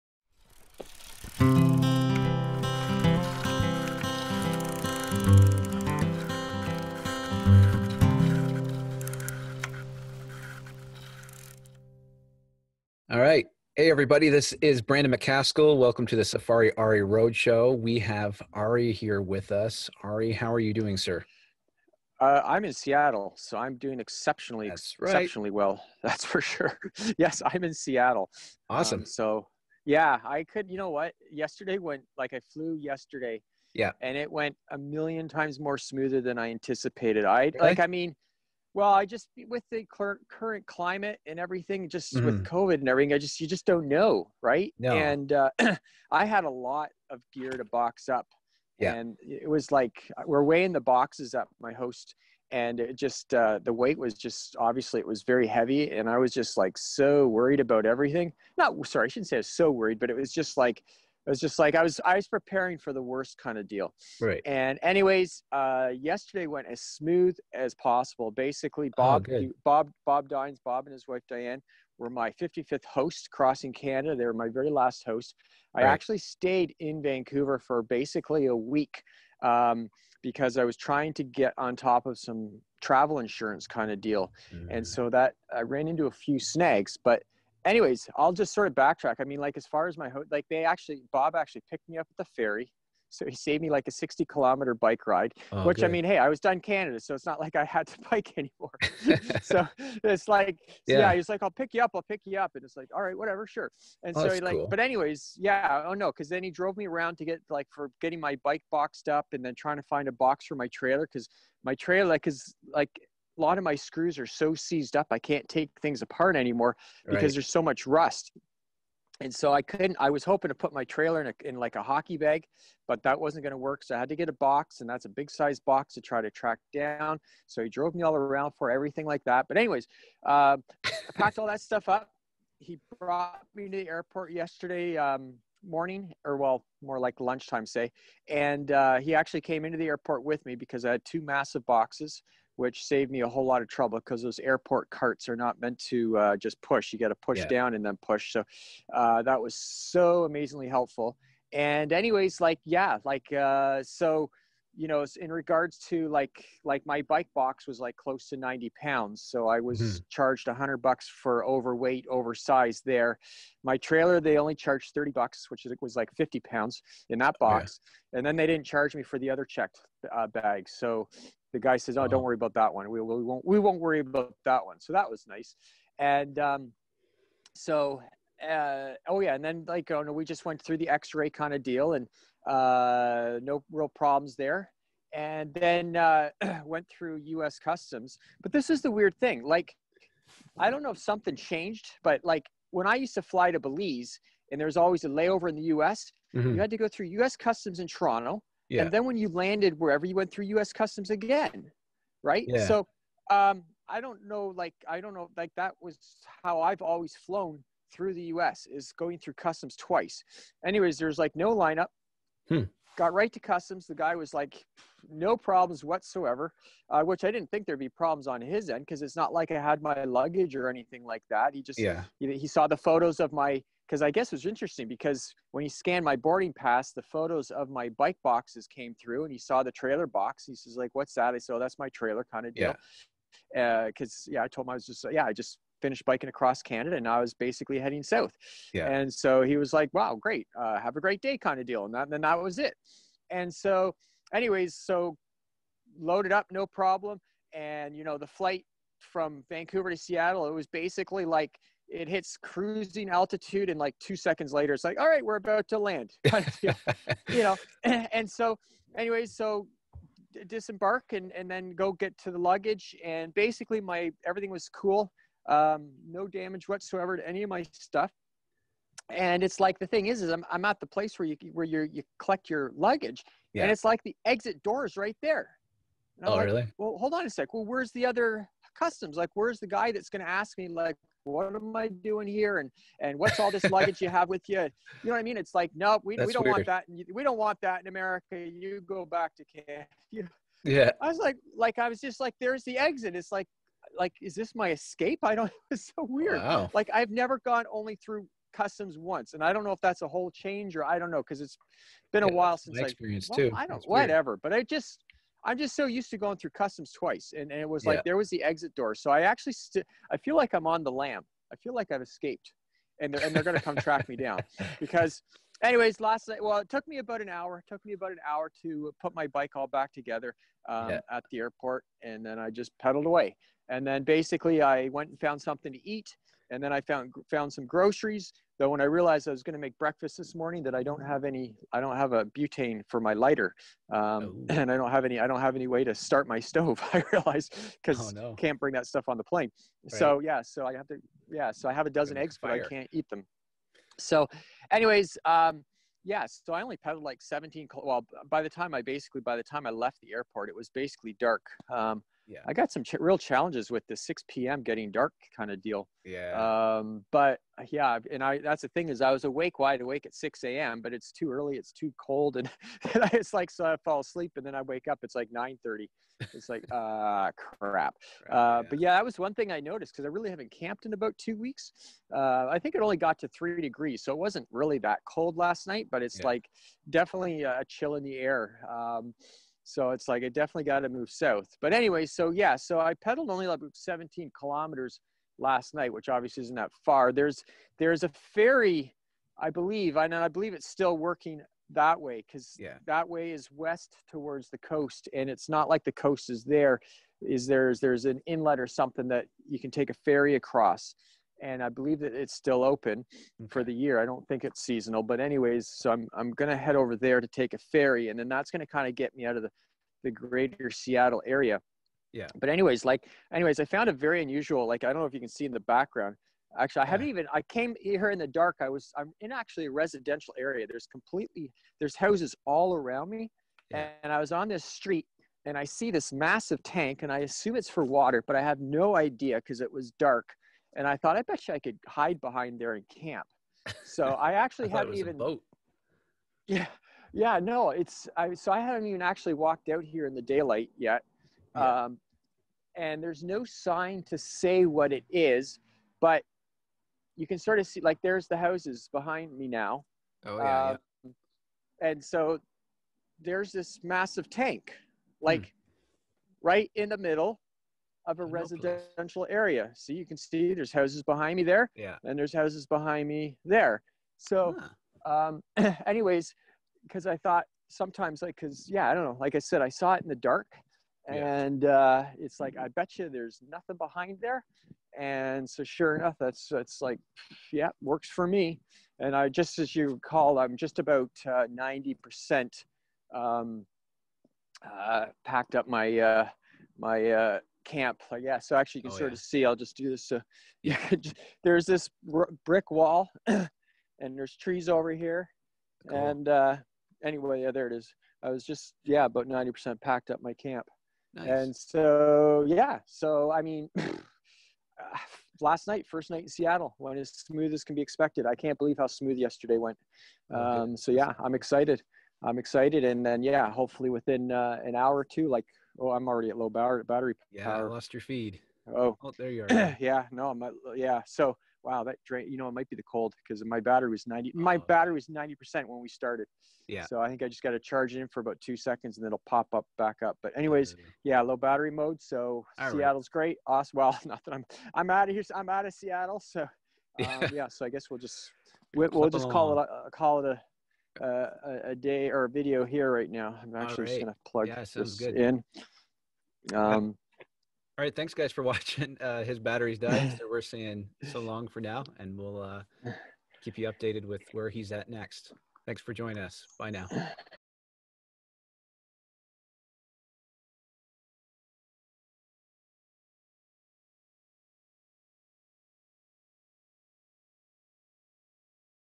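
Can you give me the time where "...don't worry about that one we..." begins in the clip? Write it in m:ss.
2:52.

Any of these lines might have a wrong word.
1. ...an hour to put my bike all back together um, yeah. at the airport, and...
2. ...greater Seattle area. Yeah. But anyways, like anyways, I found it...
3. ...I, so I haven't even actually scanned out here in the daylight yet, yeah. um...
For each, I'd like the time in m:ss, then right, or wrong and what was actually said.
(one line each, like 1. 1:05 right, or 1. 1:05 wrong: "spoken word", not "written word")
1. 5:18 right
2. 6:50 right
3. 7:18 wrong: "walked", not "scanned".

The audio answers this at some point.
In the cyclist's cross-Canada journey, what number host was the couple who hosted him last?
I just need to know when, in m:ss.
1:12.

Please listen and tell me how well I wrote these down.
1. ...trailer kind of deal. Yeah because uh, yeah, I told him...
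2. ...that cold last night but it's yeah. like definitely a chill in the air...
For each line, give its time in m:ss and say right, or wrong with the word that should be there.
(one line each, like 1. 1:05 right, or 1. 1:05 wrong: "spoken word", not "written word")
1. 3:51 right
2. 6:14 right.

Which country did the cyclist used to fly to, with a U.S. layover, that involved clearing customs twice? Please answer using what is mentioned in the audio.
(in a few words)
Belize.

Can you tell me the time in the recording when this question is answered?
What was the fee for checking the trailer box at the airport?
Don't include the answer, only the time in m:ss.
2:44.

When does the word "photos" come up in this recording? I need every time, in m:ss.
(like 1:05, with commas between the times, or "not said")
3:42, 3:47.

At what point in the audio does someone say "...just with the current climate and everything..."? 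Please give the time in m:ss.
0:39.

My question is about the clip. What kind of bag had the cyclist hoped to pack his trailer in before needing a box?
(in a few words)
hockey bag.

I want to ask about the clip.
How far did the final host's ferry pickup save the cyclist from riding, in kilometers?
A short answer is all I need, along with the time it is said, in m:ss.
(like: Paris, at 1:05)
60 kilometers, at 1:33.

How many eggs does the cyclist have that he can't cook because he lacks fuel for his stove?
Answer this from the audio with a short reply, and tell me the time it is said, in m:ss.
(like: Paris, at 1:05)
a dozen, at 5:41.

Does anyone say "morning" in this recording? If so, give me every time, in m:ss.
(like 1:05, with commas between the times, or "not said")
2:15, 5:30.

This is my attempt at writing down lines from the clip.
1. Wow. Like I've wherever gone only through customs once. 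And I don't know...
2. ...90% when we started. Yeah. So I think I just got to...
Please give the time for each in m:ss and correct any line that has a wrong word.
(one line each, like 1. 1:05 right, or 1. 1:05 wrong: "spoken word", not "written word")
1. 4:56 wrong: "never", not "wherever"
2. 8:45 right.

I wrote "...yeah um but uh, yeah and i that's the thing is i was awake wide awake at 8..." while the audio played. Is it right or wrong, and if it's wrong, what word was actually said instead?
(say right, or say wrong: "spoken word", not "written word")
wrong: "6", not "8".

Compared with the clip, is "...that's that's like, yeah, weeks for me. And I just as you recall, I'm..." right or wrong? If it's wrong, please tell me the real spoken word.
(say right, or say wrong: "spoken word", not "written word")
wrong: "works", not "weeks".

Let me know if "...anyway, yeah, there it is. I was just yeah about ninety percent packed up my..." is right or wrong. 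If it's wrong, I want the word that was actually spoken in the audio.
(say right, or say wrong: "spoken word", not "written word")
right.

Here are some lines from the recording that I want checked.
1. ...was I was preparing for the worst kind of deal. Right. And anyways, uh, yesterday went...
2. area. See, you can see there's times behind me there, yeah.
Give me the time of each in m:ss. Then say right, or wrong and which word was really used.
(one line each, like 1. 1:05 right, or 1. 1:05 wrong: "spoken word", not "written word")
1. 1:01 right
2. 7:39 wrong: "houses", not "times".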